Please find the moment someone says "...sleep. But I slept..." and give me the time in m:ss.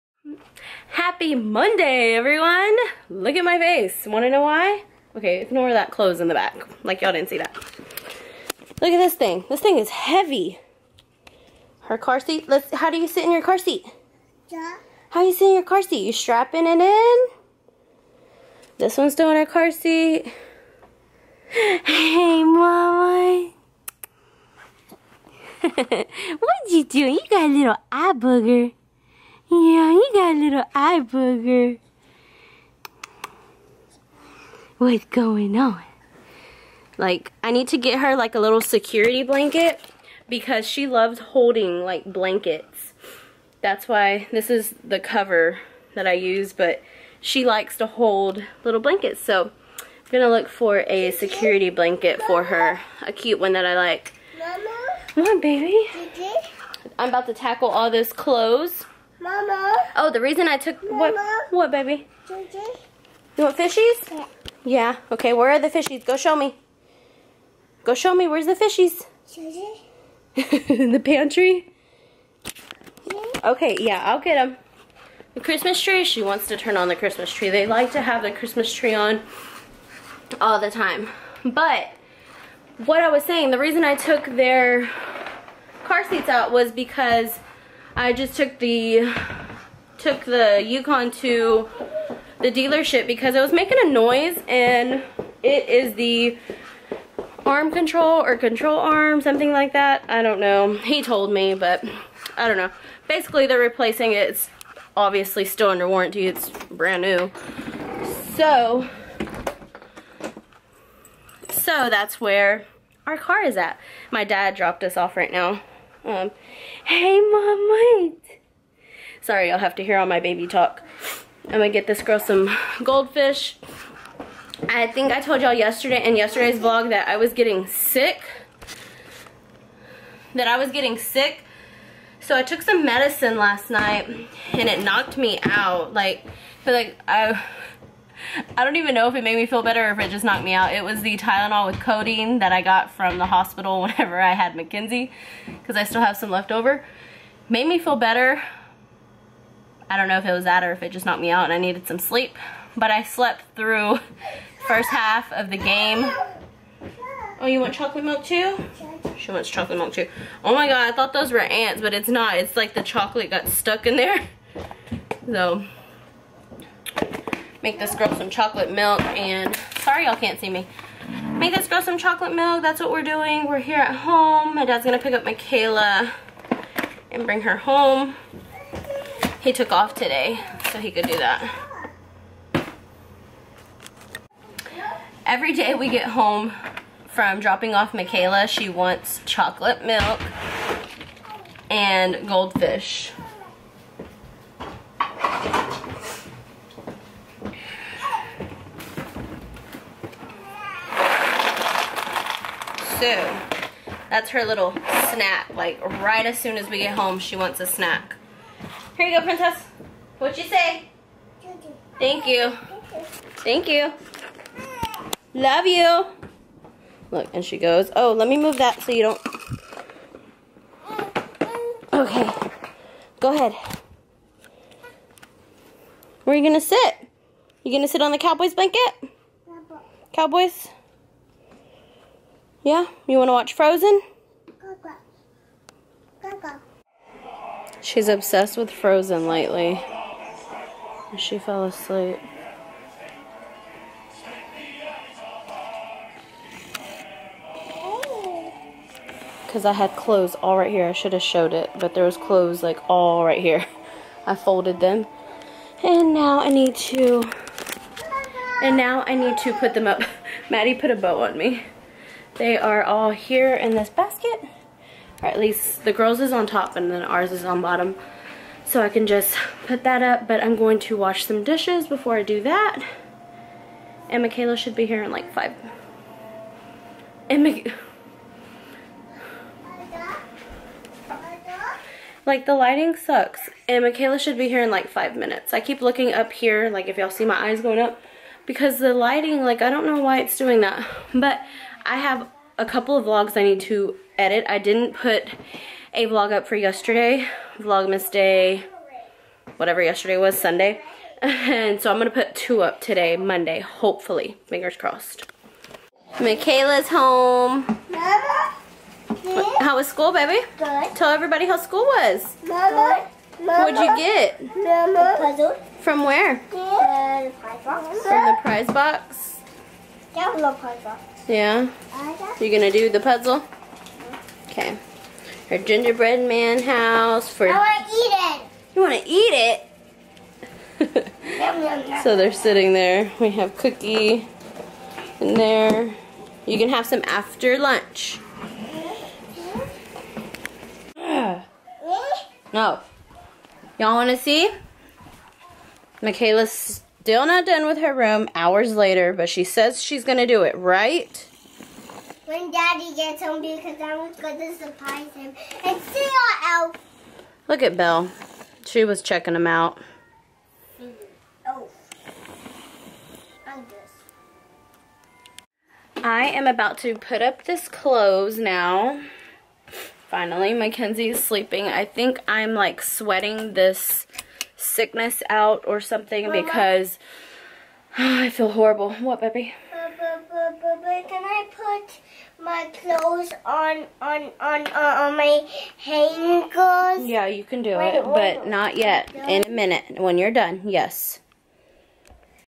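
2:31.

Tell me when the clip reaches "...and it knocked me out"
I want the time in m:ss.
2:14.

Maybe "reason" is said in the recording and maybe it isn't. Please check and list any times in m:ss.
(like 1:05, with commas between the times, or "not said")
1:00, 1:23.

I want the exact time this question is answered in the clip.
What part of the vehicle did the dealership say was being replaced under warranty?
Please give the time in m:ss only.
1:38.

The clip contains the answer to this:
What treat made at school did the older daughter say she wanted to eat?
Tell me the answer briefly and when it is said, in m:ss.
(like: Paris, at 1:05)
gingerbread man house, at 5:25.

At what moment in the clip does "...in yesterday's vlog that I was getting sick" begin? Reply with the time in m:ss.
2:06.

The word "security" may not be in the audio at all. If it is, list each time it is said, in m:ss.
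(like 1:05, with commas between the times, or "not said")
0:38, 0:51.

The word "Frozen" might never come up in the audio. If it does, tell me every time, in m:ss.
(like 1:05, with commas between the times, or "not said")
3:53, 3:58.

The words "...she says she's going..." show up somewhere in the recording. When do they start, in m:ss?
5:49.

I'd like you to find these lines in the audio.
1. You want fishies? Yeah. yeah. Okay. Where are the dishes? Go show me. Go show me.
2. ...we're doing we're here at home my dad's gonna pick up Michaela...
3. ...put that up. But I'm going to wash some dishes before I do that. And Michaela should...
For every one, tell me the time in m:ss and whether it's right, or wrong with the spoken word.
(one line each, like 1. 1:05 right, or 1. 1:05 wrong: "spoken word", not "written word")
1. 1:02 wrong: "fishies", not "dishes"
2. 2:52 right
3. 4:29 right.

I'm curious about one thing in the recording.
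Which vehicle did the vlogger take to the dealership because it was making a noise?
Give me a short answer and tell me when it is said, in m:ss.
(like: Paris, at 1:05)
Yukon, at 1:30.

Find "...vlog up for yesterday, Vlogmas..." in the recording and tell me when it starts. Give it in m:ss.
4:56.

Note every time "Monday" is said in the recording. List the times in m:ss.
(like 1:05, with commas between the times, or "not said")
0:01, 5:03.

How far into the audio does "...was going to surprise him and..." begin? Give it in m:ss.
5:53.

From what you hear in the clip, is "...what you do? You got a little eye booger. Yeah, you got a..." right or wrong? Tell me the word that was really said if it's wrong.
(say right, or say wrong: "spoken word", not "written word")
right.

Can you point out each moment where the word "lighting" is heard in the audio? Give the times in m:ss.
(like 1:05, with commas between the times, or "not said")
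4:42, 4:48.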